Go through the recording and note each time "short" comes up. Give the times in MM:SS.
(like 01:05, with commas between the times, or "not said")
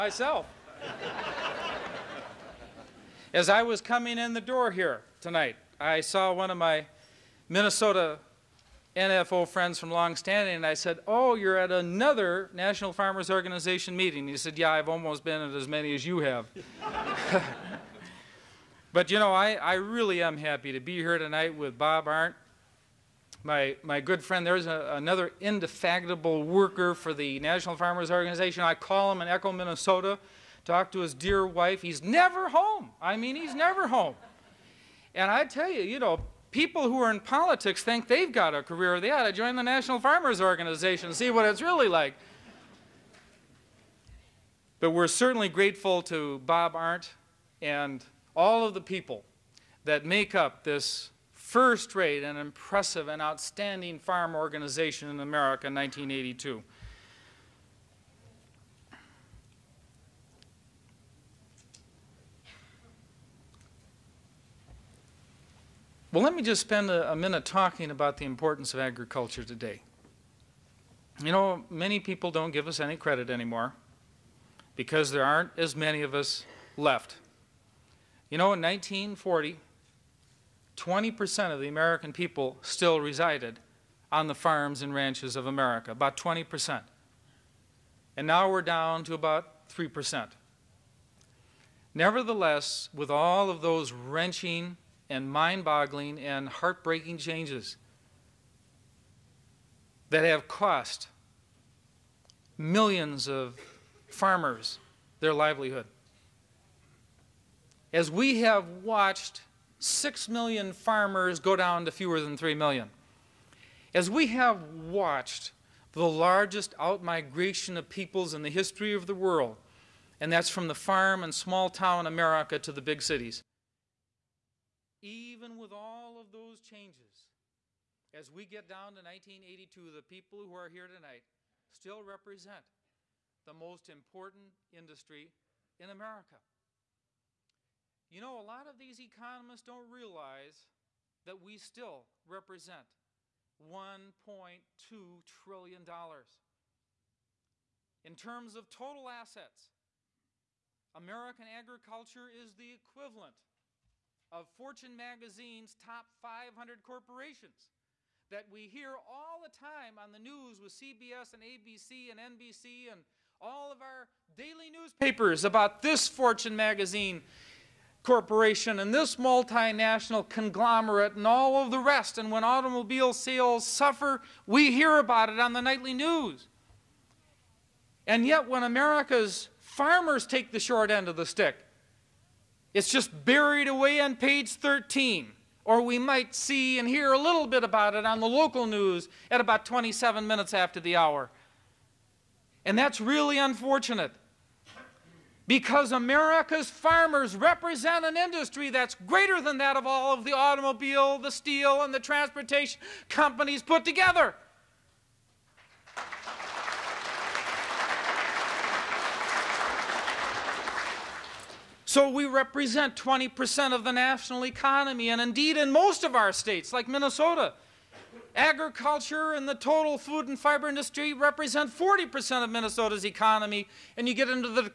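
03:00.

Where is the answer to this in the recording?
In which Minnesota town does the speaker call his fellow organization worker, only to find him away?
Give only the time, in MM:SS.
00:29.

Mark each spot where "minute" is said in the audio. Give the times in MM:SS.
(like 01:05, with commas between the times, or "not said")
01:07, 03:10.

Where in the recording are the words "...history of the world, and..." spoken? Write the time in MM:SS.
01:58.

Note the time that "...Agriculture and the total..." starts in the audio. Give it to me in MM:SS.
03:38.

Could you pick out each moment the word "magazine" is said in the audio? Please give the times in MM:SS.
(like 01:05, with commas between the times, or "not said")
02:34, 02:46.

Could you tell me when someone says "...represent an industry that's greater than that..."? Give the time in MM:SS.
03:17.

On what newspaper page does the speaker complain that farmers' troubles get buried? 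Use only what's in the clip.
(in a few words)
13.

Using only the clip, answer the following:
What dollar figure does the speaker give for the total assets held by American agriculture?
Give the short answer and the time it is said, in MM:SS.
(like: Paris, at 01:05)
$1.2 trillion, at 02:23.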